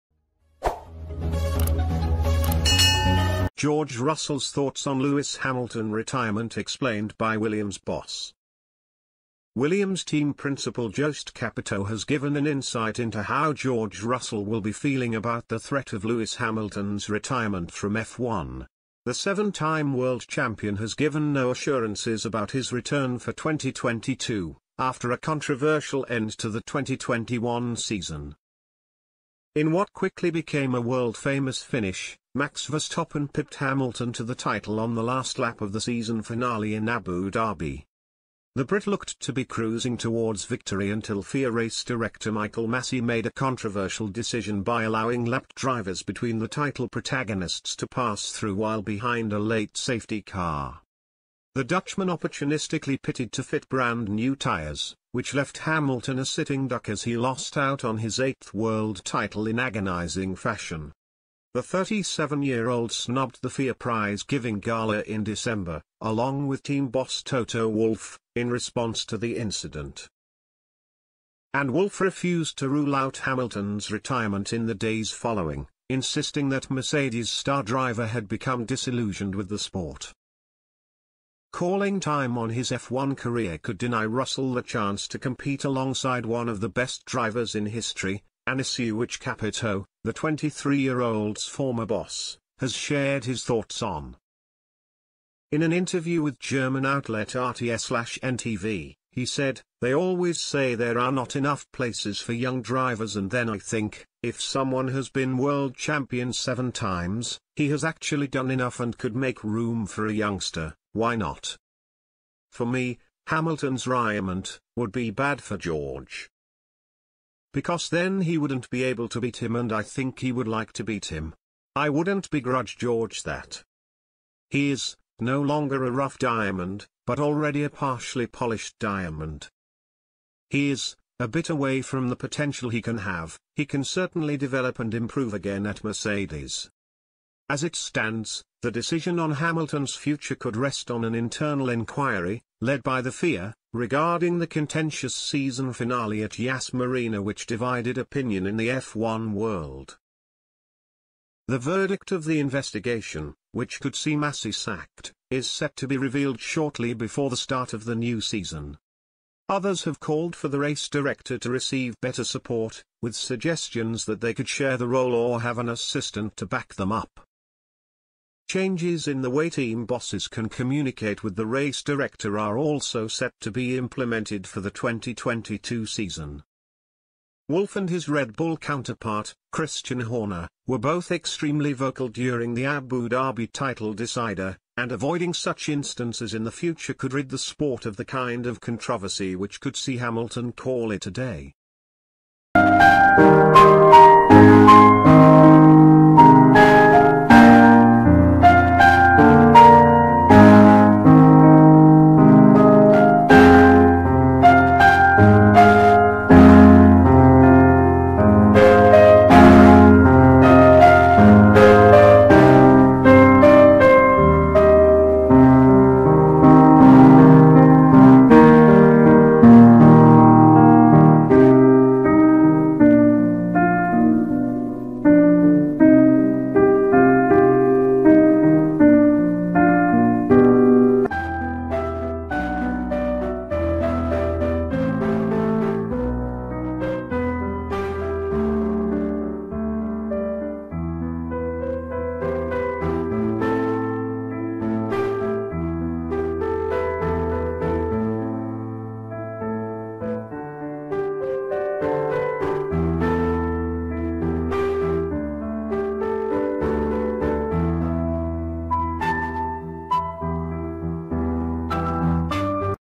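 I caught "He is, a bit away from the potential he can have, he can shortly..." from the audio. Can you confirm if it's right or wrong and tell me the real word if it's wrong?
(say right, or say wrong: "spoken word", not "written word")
wrong: "certainly", not "shortly".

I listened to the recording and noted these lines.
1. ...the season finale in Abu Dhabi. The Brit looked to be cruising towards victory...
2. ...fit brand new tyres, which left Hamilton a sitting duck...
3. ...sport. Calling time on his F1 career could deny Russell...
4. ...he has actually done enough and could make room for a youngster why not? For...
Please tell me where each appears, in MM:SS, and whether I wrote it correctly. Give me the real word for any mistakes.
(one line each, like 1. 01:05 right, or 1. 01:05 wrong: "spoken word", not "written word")
1. 00:35 right
2. 00:53 right
3. 01:19 right
4. 01:47 right.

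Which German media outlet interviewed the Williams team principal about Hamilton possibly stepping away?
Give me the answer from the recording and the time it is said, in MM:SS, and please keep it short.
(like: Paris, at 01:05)
RTS/NTV, at 01:37.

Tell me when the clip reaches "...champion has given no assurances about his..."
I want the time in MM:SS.
00:20.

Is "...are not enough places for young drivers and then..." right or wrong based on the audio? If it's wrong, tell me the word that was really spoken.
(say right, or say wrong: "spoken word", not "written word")
right.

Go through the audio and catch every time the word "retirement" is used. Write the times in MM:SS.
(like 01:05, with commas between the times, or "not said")
00:05, 00:17, 01:13.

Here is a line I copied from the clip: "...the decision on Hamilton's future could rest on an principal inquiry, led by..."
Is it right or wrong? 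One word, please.
wrong.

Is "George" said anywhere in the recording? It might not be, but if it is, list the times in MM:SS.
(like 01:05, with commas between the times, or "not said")
00:03, 00:13, 01:55, 02:02.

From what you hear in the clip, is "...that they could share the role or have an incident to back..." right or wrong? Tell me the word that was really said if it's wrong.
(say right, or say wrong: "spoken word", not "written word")
wrong: "assistant", not "incident".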